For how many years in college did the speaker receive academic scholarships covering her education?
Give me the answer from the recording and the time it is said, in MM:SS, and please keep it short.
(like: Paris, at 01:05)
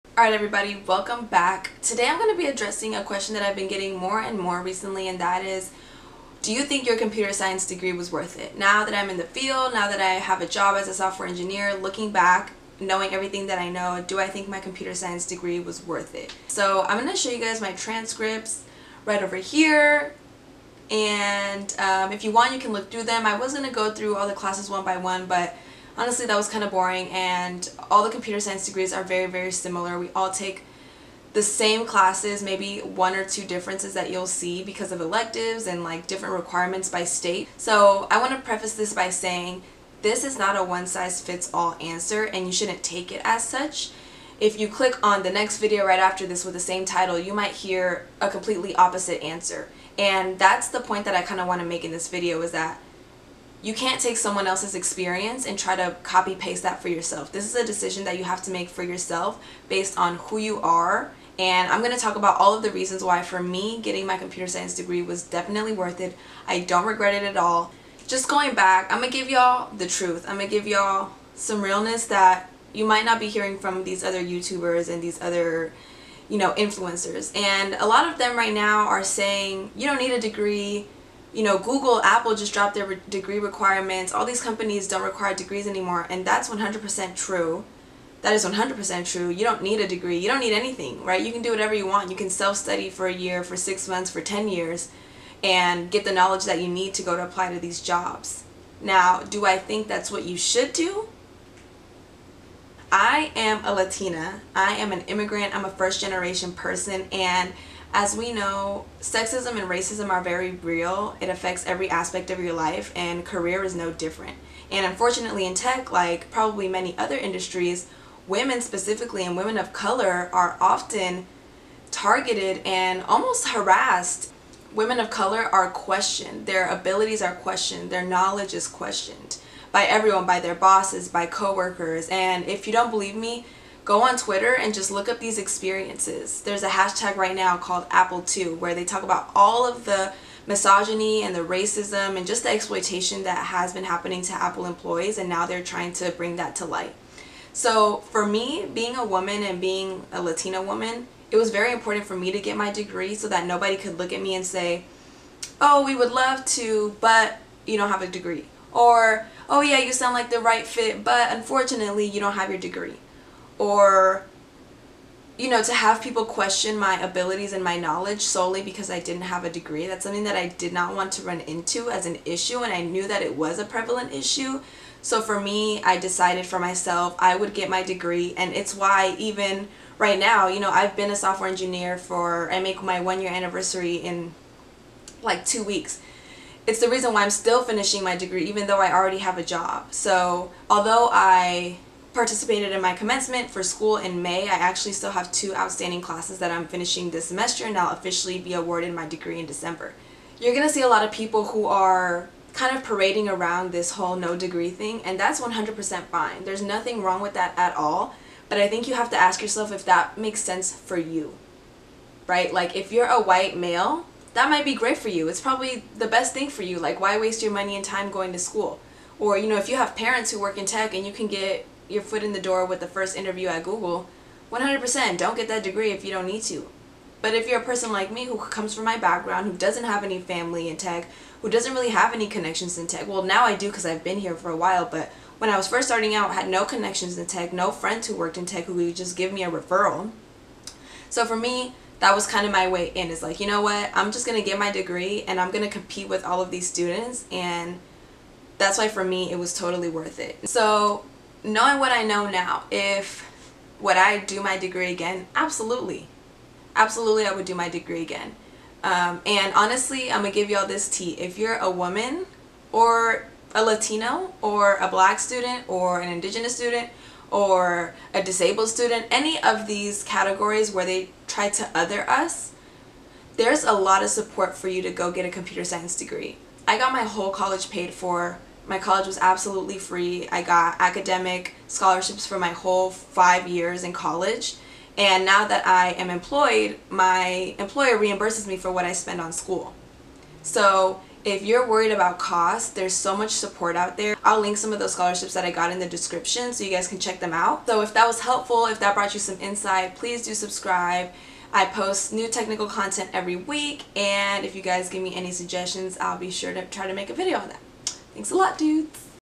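5, at 04:42.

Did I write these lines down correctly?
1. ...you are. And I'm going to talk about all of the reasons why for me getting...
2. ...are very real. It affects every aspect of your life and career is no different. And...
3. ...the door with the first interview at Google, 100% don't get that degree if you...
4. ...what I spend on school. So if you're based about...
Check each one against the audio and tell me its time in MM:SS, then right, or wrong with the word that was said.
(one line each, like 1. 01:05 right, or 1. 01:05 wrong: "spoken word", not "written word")
1. 01:00 right
2. 01:50 right
3. 03:42 right
4. 04:48 wrong: "worried", not "based".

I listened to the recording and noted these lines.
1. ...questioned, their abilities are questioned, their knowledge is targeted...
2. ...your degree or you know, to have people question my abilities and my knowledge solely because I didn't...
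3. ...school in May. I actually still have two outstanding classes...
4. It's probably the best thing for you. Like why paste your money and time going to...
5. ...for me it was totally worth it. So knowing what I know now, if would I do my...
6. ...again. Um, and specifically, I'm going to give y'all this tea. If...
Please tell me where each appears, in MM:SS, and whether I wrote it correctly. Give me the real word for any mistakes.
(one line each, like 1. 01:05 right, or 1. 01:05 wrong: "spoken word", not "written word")
1. 02:05 wrong: "questioned", not "targeted"
2. 02:42 right
3. 03:13 right
4. 03:35 wrong: "waste", not "paste"
5. 04:08 right
6. 04:18 wrong: "honestly", not "specifically".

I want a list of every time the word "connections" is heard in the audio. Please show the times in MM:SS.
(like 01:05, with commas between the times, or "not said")
03:52, 03:56.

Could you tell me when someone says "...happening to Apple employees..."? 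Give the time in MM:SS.
02:23.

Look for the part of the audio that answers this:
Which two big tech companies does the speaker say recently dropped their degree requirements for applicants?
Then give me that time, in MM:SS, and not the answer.
01:21.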